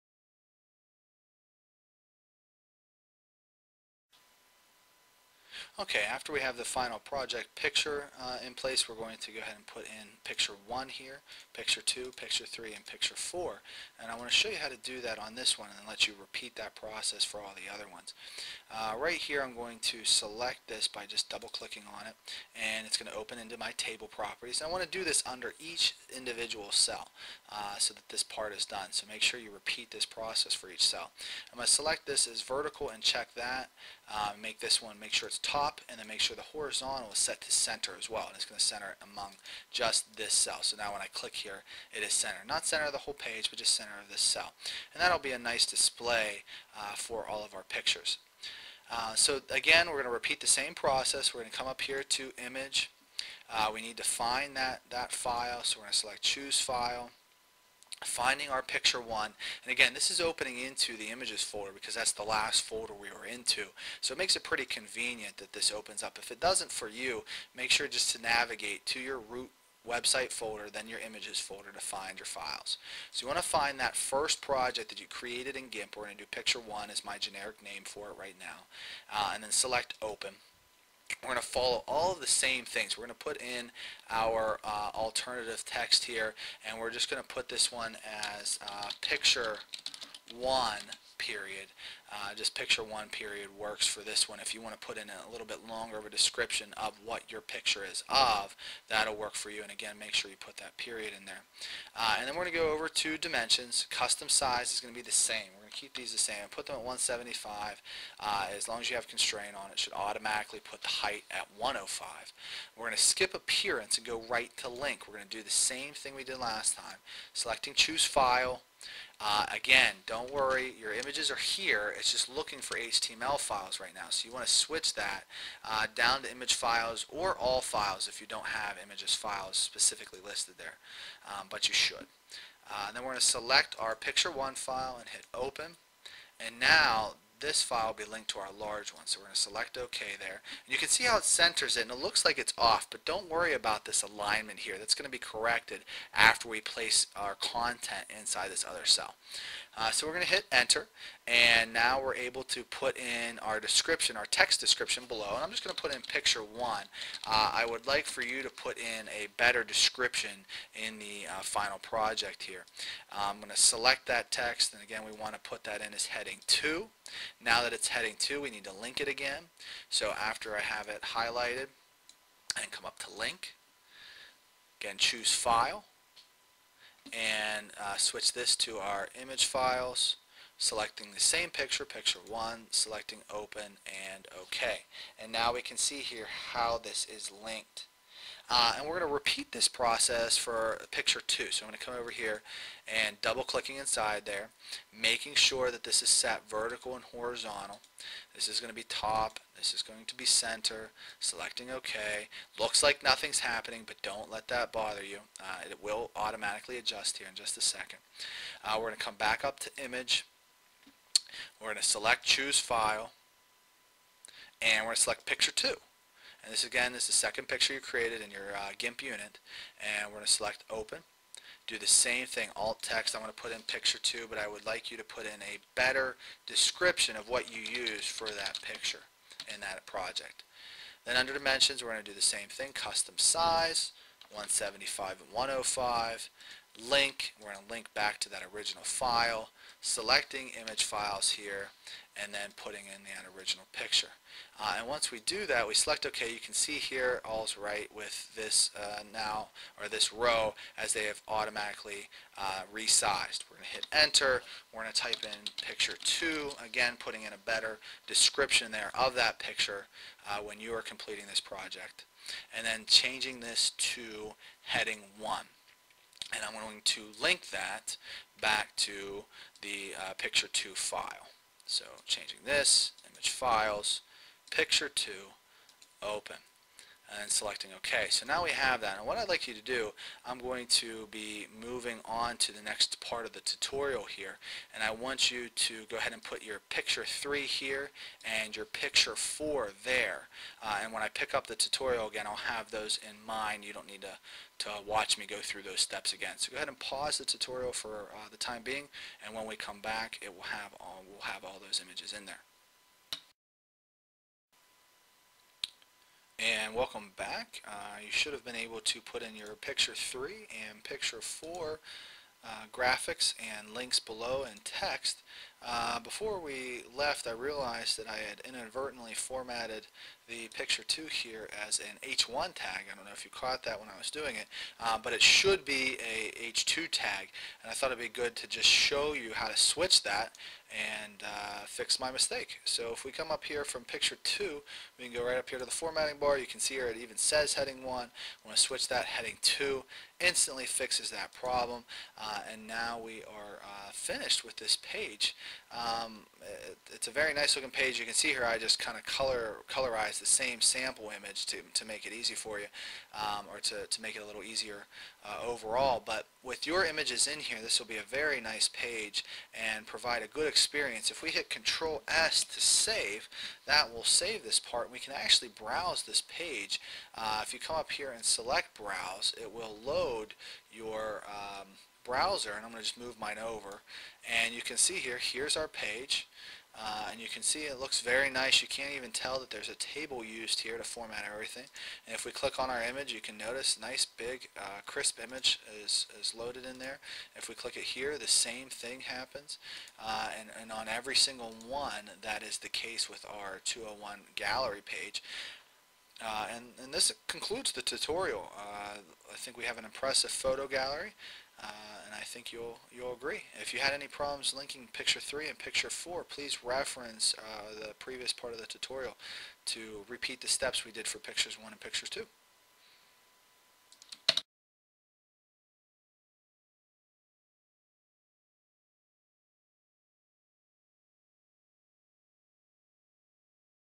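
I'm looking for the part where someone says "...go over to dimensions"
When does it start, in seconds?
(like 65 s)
102 s.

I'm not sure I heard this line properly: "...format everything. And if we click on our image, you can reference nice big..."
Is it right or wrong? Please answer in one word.
wrong.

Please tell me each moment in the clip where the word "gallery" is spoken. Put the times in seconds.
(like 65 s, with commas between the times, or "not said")
394 s, 400 s.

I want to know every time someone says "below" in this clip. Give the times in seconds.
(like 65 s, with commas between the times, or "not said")
155 s, 313 s.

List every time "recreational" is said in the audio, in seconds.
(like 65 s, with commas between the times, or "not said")
not said.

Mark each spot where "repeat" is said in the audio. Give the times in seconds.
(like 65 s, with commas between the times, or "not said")
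16 s, 29 s, 50 s, 189 s, 410 s.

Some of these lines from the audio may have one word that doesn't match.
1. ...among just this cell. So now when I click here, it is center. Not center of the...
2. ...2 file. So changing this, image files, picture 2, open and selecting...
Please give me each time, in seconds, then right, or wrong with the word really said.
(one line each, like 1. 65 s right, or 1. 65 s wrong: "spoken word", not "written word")
1. 39 s right
2. 270 s right.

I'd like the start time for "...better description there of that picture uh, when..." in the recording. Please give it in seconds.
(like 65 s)
257 s.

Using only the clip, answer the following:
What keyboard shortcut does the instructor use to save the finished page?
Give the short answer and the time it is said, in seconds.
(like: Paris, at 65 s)
Control S, at 361 s.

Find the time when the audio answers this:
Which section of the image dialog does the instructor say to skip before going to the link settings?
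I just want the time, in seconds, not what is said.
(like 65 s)
113 s.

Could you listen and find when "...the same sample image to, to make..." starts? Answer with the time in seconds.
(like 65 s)
350 s.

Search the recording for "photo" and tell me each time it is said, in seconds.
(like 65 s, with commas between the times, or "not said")
400 s.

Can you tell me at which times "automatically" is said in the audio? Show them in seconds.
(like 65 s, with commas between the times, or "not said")
109 s, 206 s, 251 s.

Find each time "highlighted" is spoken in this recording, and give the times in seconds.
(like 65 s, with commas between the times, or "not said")
171 s.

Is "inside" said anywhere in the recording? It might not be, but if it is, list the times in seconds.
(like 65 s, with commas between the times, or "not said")
148 s, 193 s.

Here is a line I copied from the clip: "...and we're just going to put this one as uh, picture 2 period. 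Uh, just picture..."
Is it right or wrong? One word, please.
wrong.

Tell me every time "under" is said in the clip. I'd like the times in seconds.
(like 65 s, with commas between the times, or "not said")
25 s, 231 s.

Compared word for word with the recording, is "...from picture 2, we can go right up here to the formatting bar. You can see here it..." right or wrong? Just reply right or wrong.
right.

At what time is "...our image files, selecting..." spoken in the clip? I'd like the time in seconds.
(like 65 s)
178 s.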